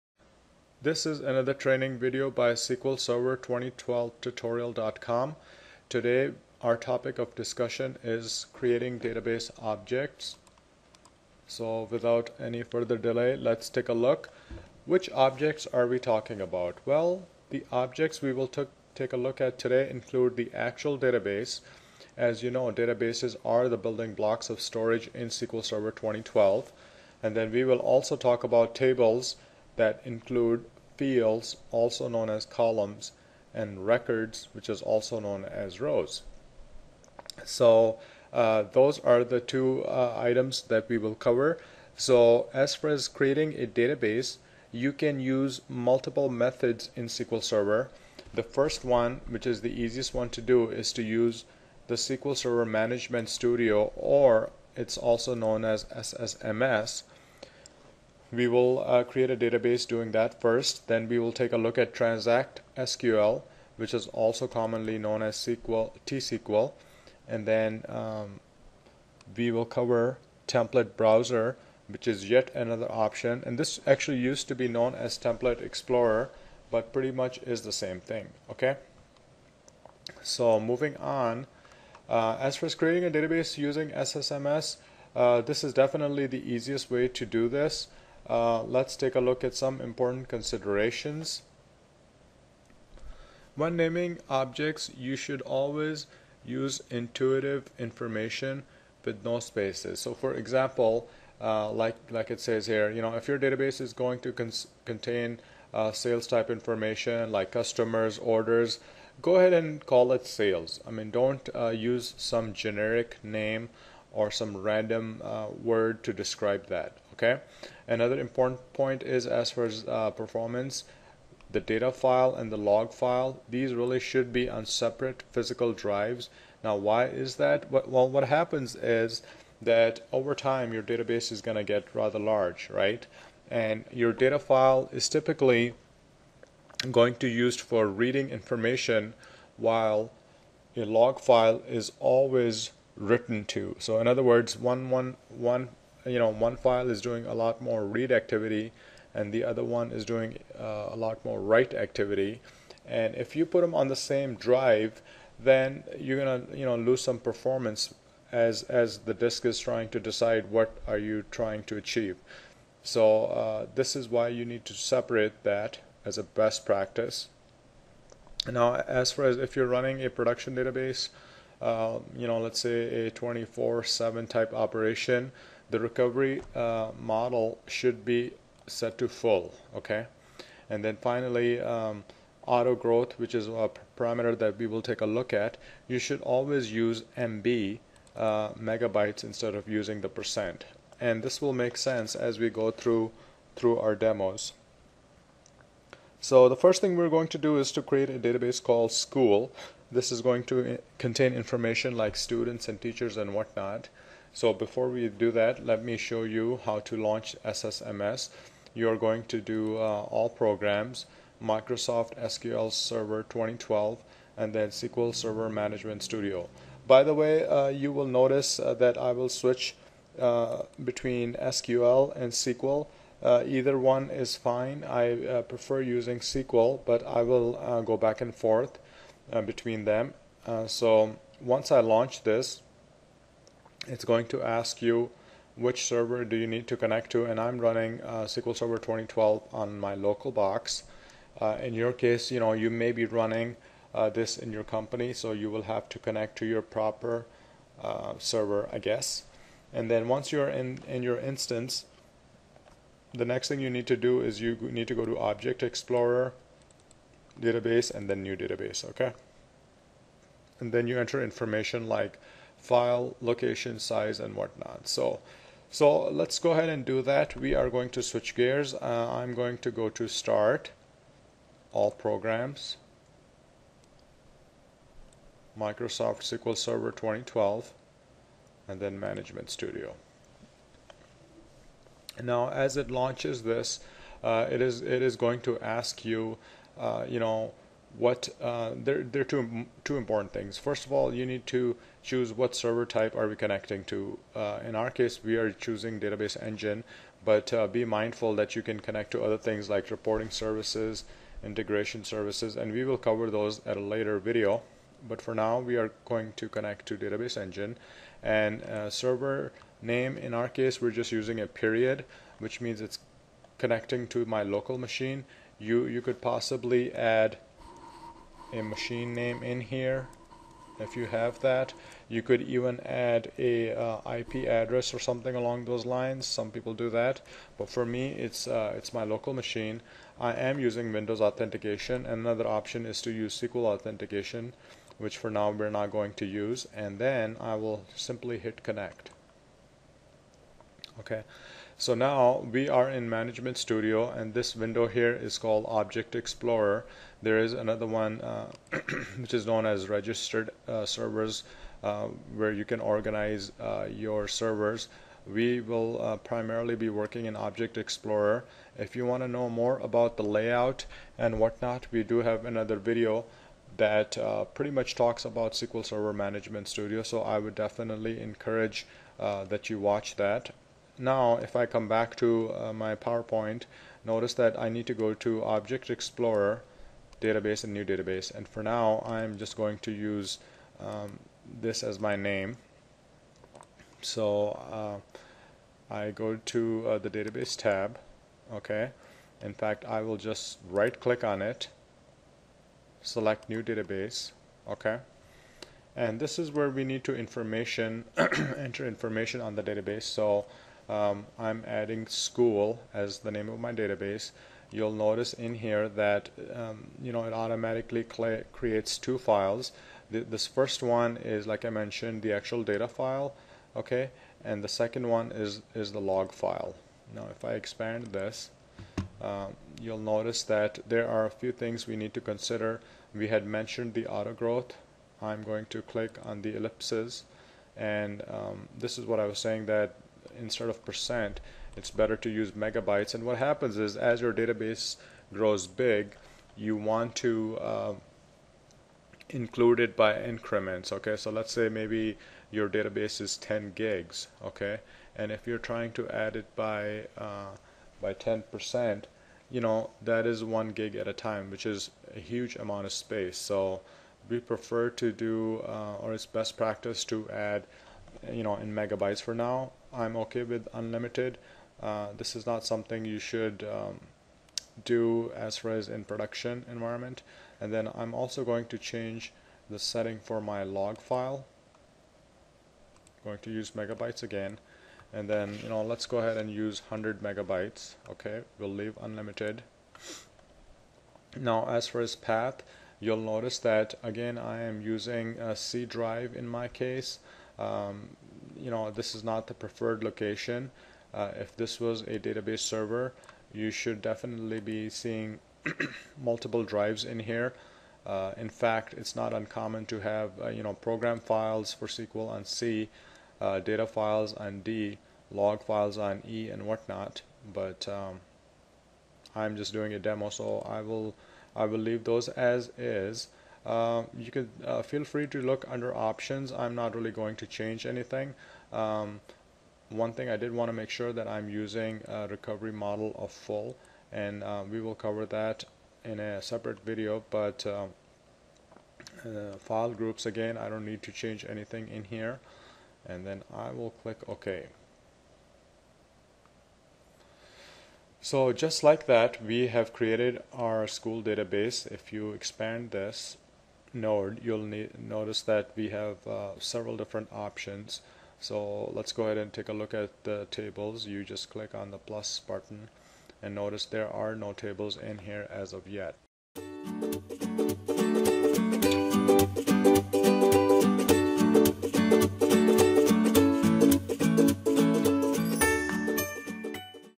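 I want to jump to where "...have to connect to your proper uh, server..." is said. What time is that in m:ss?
4:05.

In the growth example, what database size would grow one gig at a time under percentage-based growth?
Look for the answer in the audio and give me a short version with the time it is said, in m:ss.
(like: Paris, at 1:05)
10 gigs, at 7:23.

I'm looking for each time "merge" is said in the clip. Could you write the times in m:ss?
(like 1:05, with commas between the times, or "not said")
not said.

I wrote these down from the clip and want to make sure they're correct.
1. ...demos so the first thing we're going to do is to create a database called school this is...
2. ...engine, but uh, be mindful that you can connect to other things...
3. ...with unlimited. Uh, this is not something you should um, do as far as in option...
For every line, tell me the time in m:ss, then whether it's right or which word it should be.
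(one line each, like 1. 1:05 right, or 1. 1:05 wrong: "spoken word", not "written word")
1. 3:13 right
2. 4:56 right
3. 7:40 wrong: "production", not "option".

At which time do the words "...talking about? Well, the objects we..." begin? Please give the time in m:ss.
0:15.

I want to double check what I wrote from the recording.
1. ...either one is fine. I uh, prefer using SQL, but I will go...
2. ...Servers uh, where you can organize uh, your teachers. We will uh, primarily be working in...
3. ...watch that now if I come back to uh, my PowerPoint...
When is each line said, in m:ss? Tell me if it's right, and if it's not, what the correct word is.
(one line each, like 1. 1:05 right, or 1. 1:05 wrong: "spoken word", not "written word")
1. 3:43 right
2. 5:50 wrong: "servers", not "teachers"
3. 6:09 right.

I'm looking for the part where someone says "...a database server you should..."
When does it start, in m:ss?
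8:12.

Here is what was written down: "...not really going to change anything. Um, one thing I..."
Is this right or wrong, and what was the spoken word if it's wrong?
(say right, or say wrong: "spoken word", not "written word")
right.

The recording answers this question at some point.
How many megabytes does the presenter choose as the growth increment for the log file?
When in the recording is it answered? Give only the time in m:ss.
7:56.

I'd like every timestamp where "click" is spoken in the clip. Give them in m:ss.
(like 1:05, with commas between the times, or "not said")
6:30, 7:05, 8:54, 9:11.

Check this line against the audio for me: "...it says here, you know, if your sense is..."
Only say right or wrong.
wrong.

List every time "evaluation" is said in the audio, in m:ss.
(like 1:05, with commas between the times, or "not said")
not said.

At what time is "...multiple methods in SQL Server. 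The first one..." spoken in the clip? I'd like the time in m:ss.
0:45.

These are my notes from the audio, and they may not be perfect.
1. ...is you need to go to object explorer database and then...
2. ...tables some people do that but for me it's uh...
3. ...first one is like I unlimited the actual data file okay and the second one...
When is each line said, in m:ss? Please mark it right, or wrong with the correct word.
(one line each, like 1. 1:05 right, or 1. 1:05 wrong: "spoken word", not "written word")
1. 4:14 right
2. 5:25 wrong: "lines", not "tables"
3. 6:50 wrong: "mentioned", not "unlimited".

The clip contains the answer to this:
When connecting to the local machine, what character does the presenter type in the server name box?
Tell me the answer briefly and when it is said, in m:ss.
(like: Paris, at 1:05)
a period, at 5:10.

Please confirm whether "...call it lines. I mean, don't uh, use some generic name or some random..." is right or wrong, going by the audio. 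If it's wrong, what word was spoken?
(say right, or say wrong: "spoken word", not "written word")
wrong: "sales", not "lines".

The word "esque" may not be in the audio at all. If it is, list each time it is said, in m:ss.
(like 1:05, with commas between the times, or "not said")
not said.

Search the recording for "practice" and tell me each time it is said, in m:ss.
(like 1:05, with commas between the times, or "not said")
2:46, 7:36.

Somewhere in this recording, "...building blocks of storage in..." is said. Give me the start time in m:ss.
0:23.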